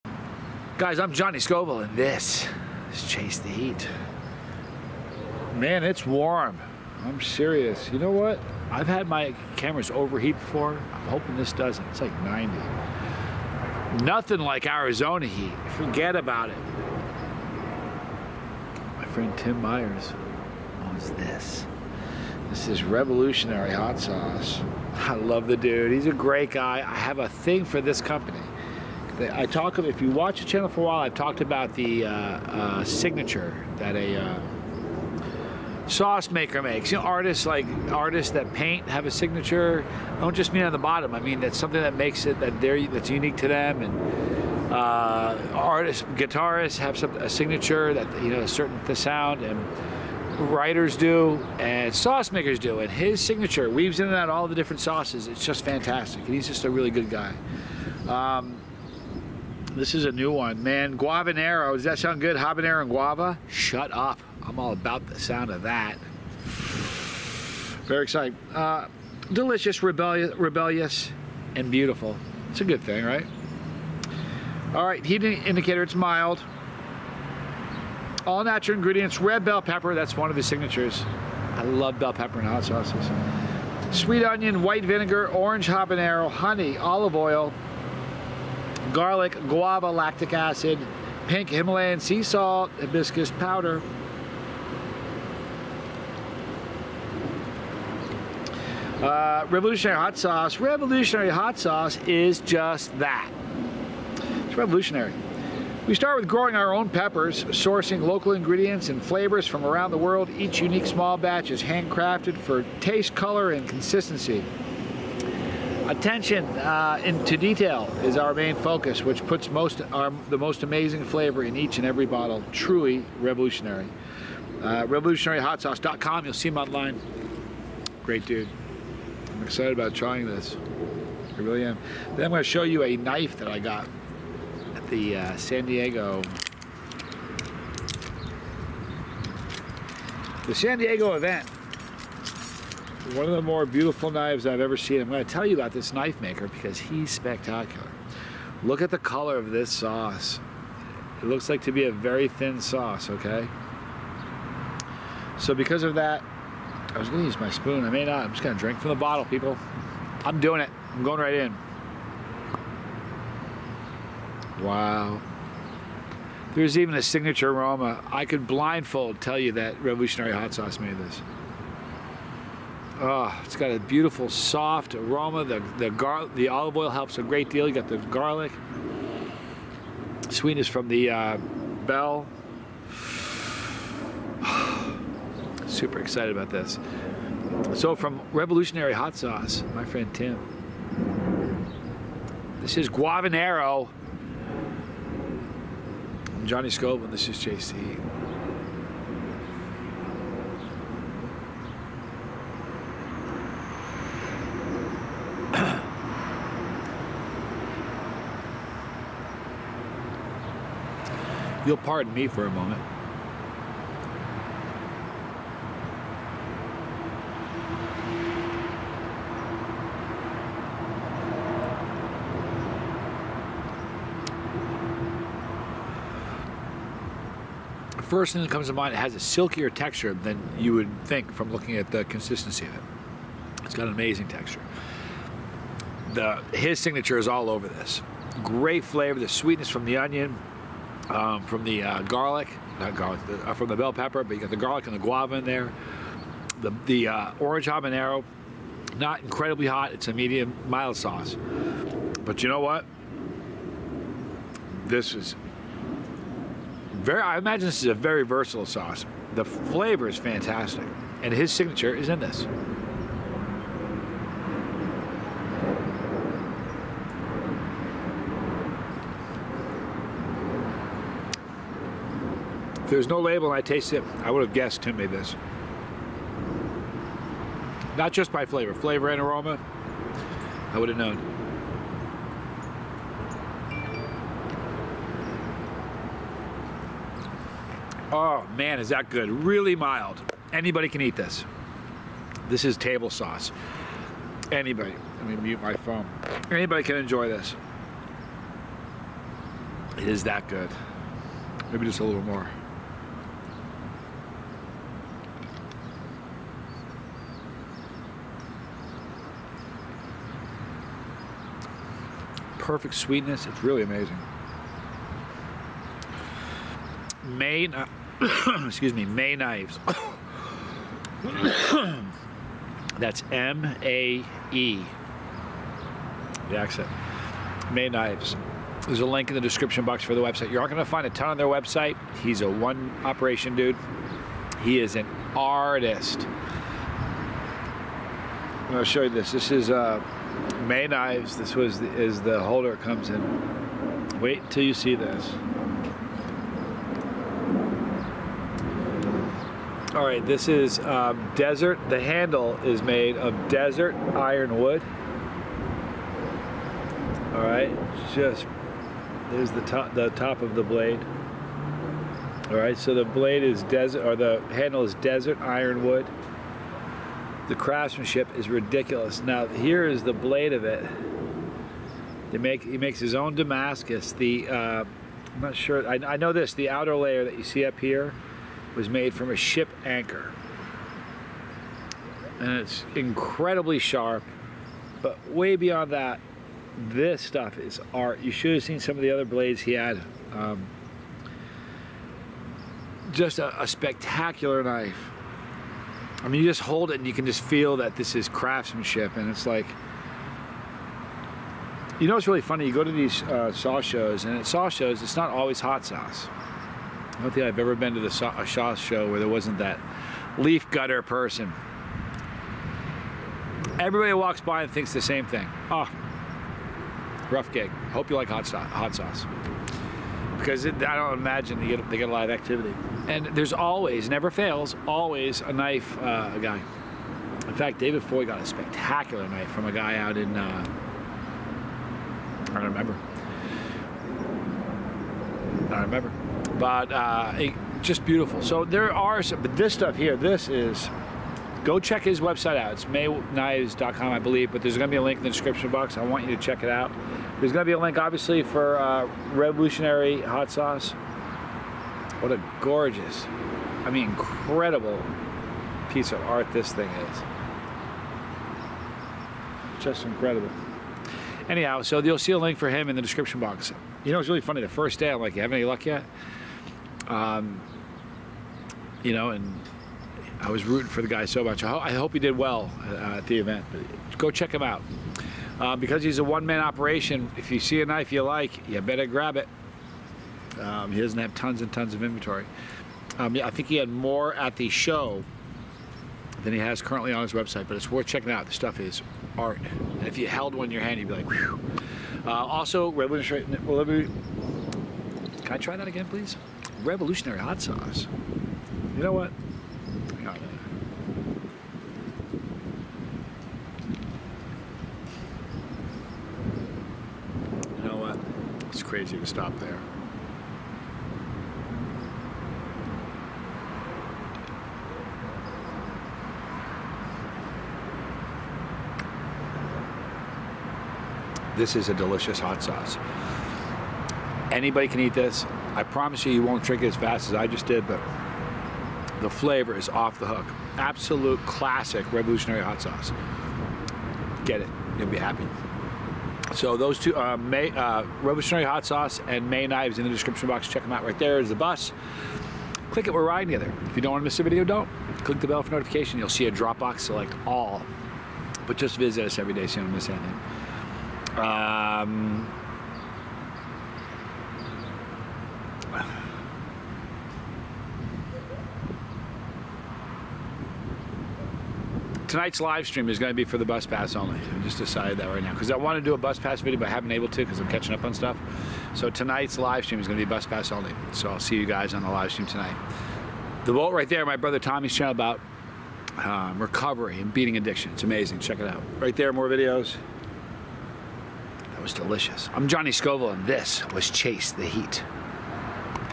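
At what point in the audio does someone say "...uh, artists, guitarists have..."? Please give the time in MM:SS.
00:44.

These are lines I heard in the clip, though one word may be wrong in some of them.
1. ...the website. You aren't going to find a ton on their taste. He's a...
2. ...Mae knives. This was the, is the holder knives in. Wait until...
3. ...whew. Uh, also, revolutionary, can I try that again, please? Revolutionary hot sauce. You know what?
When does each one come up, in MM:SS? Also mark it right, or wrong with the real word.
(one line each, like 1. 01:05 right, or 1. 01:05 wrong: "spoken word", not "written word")
1. 05:30 wrong: "website", not "taste"
2. 05:40 wrong: "comes", not "knives"
3. 08:11 right.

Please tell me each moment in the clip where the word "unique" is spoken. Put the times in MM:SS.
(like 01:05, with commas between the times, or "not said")
00:43, 01:50.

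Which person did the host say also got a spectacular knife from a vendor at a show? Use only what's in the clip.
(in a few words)
David Foy.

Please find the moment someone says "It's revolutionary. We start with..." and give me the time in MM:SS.
01:44.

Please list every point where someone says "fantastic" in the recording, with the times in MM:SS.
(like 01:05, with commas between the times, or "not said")
00:55, 04:20.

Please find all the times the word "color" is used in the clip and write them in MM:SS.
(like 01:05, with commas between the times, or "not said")
01:53, 02:28.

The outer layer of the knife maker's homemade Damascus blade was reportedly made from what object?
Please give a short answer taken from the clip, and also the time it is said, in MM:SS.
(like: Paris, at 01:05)
A ship anchor, at 06:19.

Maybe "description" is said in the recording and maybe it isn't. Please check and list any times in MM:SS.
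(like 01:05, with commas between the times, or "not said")
05:29, 07:25, 07:43, 09:00.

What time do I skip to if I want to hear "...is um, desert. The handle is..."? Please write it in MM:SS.
05:50.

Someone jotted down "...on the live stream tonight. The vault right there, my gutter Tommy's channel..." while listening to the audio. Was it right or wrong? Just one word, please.
wrong.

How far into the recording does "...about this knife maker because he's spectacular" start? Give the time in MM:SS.
02:25.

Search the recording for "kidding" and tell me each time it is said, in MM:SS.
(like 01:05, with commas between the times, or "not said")
not said.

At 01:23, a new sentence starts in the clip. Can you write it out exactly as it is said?
Sweet onion, white vinegar, orange habanero, honey, olive oil, garlic, guava, lactic acid, pink Himalayan sea salt, hibiscus powder.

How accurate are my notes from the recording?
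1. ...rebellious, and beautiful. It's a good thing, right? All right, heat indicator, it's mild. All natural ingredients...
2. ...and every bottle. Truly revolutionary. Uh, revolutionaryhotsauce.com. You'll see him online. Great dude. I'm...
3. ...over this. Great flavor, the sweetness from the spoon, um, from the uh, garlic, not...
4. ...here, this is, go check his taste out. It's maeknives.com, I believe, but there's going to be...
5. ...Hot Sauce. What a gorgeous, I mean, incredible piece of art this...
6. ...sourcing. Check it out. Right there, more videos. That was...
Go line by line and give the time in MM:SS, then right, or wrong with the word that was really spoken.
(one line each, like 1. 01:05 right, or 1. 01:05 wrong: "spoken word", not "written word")
1. 01:10 right
2. 02:01 right
3. 03:57 wrong: "onion", not "spoon"
4. 07:19 wrong: "website", not "taste"
5. 07:30 right
6. 09:38 wrong: "amazing", not "sourcing".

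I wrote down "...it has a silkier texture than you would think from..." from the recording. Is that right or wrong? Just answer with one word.
right.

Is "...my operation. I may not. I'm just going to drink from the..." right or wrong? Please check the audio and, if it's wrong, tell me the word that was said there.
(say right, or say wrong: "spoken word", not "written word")
wrong: "spoon", not "operation".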